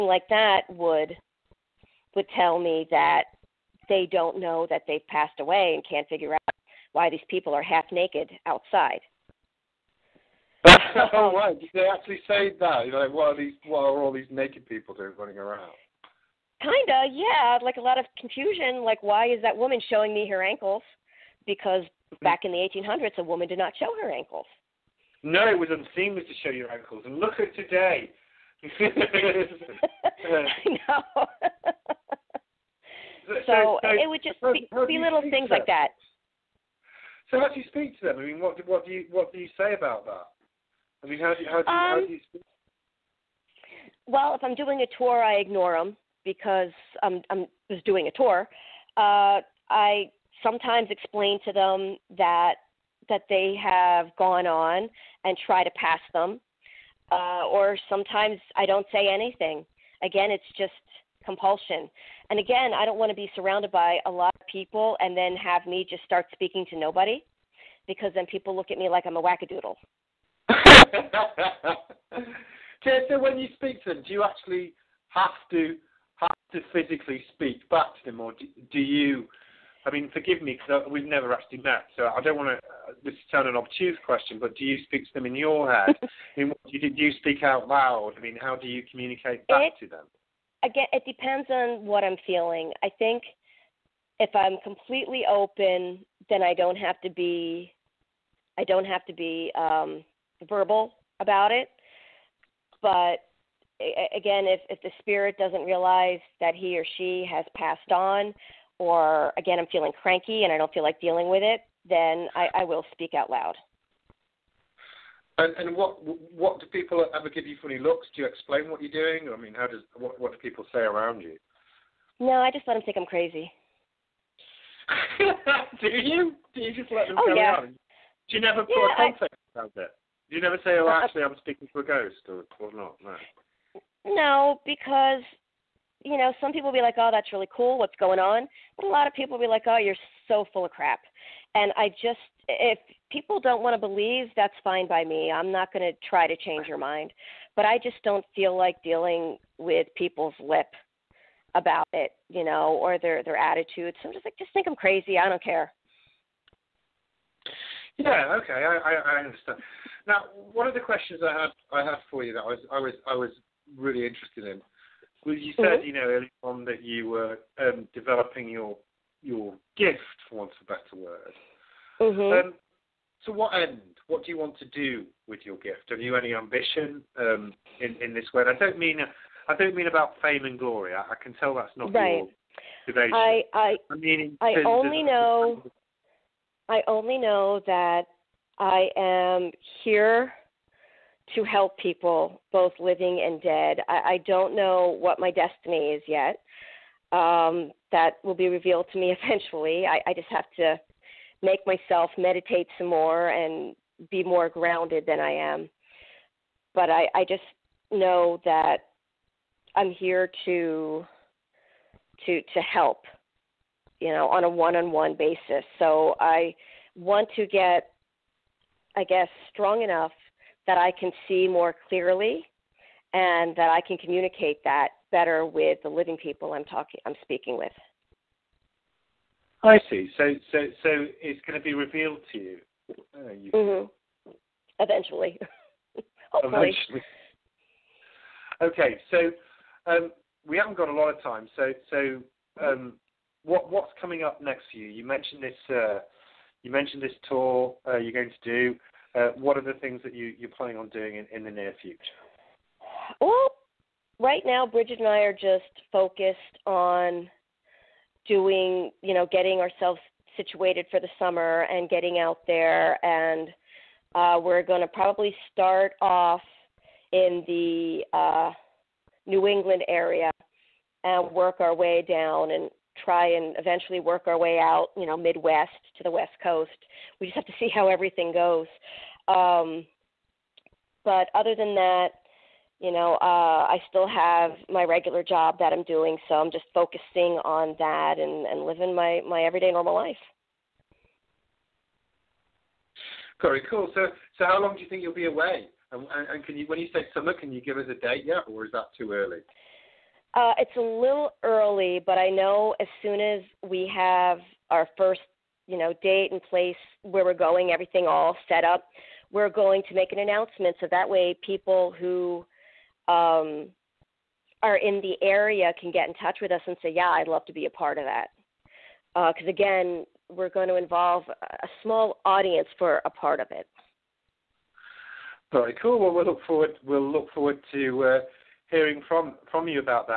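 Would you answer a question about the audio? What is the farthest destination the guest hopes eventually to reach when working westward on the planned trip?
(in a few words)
West Coast.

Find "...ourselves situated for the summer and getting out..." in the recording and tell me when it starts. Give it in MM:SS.
04:19.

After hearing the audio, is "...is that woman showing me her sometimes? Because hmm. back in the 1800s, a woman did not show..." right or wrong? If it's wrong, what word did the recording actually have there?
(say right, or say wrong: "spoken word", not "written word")
wrong: "ankles", not "sometimes".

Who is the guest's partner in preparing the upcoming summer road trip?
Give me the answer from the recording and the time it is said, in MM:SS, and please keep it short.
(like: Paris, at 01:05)
Bridget, at 04:14.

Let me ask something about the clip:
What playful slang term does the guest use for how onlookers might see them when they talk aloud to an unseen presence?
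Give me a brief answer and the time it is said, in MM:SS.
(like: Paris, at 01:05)
Wackadoodle, at 01:09.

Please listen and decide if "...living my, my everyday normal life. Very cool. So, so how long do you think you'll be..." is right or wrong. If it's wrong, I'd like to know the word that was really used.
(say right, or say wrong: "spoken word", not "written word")
right.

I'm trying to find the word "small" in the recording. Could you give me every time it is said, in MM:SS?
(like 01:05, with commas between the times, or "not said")
05:21.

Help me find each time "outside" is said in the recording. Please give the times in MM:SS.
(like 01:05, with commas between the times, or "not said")
00:08.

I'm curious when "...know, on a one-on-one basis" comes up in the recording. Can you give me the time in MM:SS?
03:34.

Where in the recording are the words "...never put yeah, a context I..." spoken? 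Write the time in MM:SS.
02:08.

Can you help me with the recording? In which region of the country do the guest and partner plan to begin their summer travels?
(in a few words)
New England.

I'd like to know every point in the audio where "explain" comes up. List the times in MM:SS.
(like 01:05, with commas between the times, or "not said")
00:50, 01:58.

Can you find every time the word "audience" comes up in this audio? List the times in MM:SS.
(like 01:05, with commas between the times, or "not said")
05:22.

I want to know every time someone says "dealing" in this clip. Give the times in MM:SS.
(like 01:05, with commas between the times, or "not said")
01:51, 02:28.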